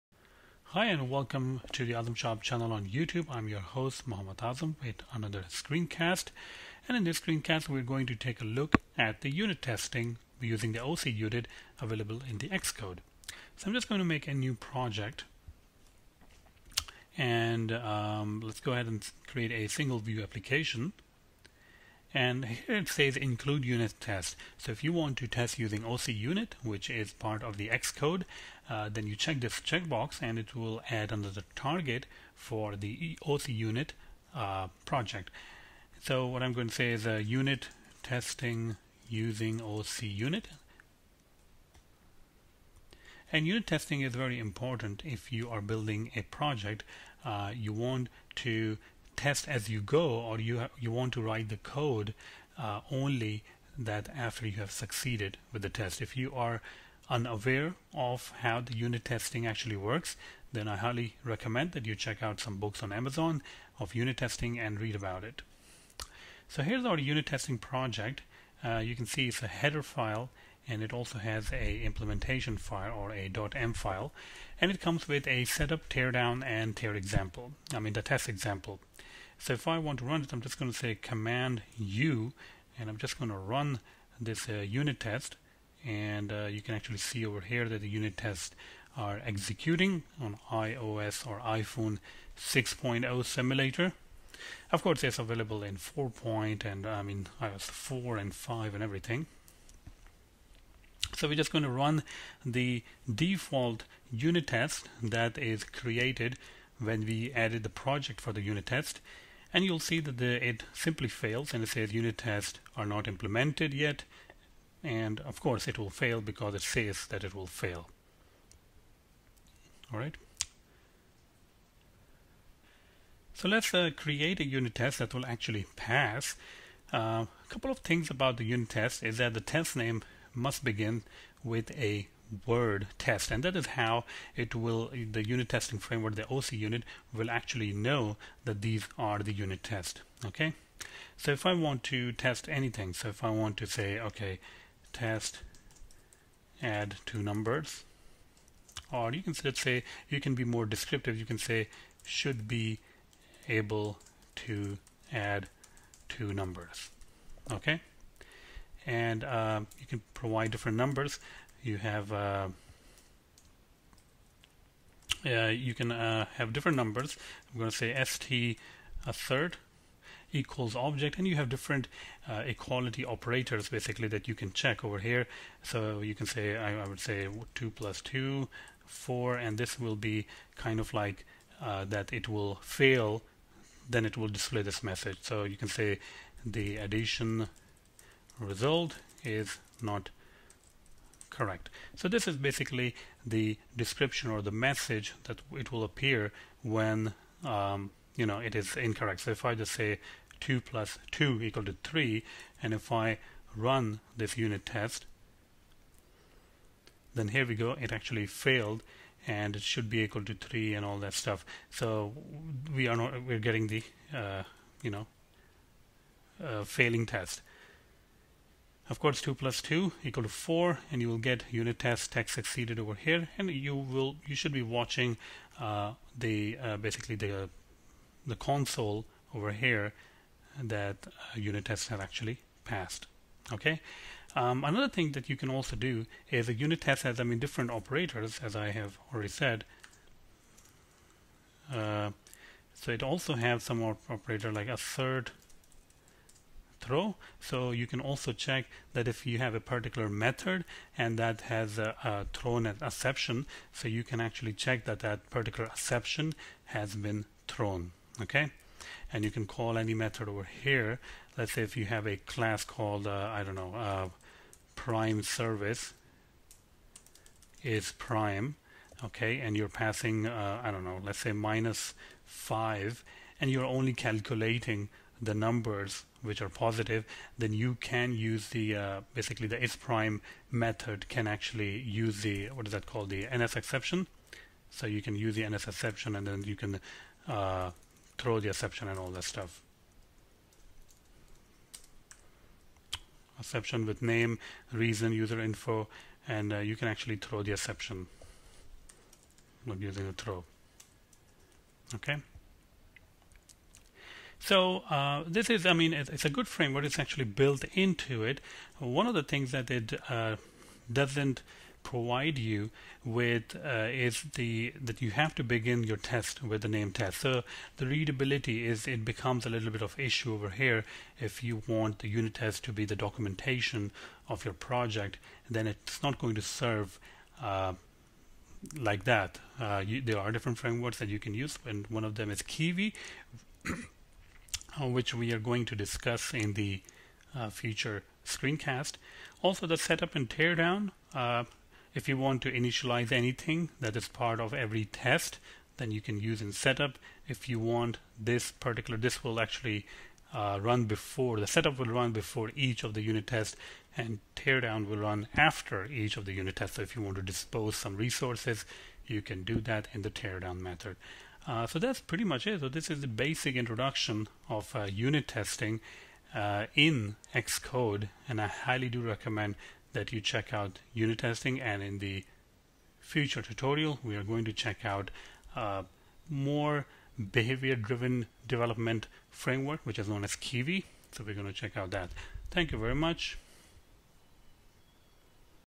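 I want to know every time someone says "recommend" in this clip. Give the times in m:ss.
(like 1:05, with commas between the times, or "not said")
1:01, 6:09.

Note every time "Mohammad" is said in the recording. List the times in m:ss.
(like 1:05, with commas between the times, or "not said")
0:04.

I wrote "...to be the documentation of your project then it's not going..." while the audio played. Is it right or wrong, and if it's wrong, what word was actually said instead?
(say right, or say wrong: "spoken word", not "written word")
right.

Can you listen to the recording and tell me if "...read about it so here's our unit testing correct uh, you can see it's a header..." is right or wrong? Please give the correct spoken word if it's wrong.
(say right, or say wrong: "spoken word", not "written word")
wrong: "project", not "correct".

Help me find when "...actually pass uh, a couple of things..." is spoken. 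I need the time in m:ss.
2:05.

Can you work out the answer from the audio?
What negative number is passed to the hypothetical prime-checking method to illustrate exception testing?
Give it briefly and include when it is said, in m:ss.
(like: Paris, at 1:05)
-5, at 4:31.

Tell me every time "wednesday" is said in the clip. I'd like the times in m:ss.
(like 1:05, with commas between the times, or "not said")
not said.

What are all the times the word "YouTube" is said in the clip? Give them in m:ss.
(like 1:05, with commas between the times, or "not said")
0:02.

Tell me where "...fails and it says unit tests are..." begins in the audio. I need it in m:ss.
1:51.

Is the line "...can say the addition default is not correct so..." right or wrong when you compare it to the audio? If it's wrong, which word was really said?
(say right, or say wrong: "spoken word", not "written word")
wrong: "result", not "default".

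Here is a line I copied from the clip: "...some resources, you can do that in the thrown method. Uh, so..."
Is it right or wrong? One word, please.
wrong.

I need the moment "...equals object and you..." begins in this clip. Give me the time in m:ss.
2:50.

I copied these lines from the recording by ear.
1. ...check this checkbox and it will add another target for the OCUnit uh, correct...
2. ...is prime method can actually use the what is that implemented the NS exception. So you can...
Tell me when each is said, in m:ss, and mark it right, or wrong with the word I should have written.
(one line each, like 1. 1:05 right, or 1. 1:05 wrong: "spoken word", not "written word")
1. 0:29 wrong: "project", not "correct"
2. 4:39 wrong: "called", not "implemented".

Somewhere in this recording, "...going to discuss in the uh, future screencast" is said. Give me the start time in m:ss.
5:35.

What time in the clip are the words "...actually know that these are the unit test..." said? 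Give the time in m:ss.
2:17.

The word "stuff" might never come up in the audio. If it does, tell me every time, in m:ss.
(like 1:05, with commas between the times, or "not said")
3:31, 4:49.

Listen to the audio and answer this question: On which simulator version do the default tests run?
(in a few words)
iPhone 6.0.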